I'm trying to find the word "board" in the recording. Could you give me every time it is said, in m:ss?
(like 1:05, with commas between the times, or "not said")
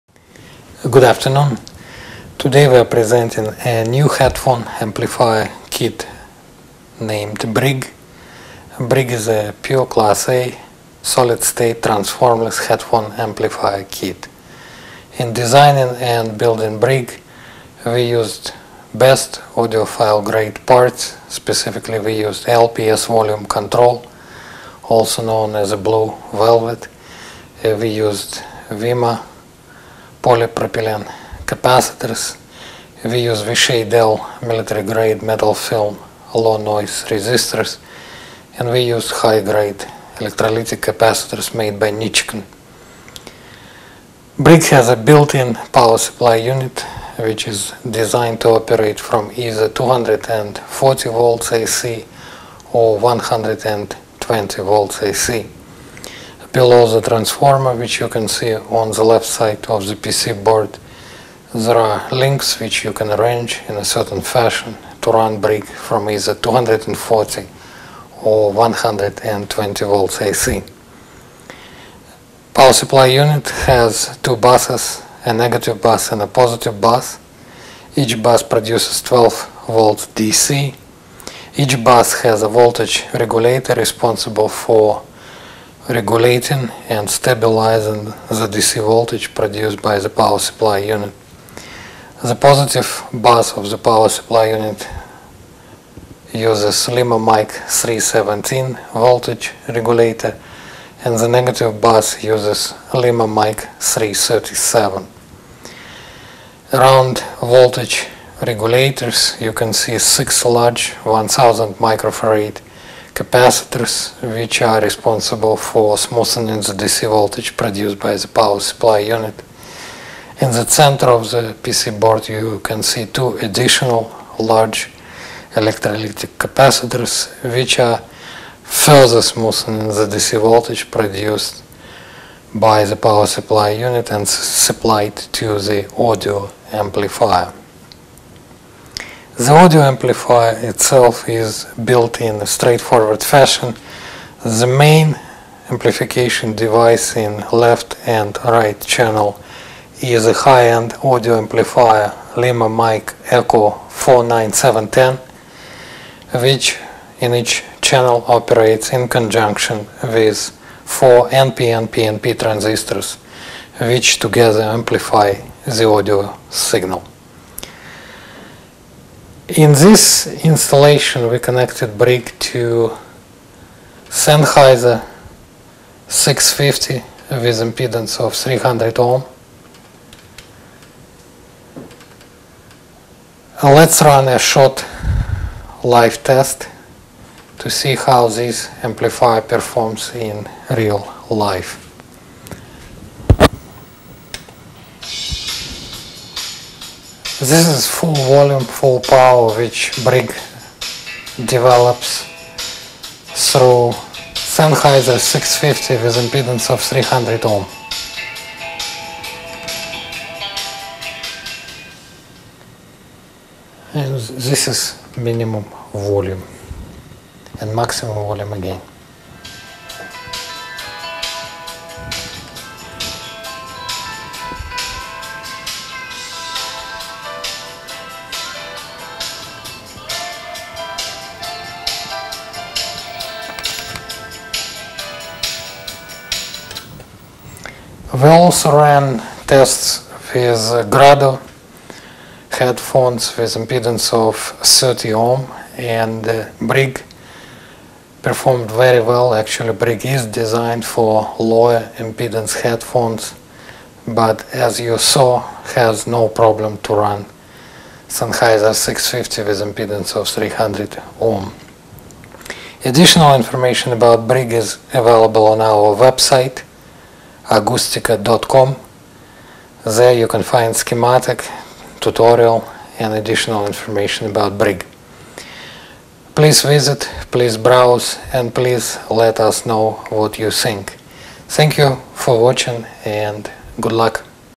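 1:00, 2:02.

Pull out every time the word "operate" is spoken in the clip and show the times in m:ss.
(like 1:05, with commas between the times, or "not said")
0:48, 2:38.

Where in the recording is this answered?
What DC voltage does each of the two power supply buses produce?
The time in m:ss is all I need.
1:19.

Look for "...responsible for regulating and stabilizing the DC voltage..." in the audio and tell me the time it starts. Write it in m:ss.
1:23.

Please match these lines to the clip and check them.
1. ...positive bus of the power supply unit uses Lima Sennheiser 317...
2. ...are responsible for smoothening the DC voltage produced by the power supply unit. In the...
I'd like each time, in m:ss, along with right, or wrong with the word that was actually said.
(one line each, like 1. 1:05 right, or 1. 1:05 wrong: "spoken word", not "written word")
1. 1:32 wrong: "Mic", not "Sennheiser"
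2. 1:54 right.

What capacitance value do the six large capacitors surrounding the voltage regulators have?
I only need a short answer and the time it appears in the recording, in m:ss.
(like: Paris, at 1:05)
1000 microfarad, at 1:51.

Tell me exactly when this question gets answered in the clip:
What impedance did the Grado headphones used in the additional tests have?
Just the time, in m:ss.
4:04.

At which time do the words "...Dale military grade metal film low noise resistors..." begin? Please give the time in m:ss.
0:33.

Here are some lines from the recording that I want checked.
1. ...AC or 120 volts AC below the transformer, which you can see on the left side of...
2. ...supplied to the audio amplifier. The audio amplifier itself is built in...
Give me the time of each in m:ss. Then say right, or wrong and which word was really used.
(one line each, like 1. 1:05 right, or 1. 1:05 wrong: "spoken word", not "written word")
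1. 0:51 right
2. 2:14 right.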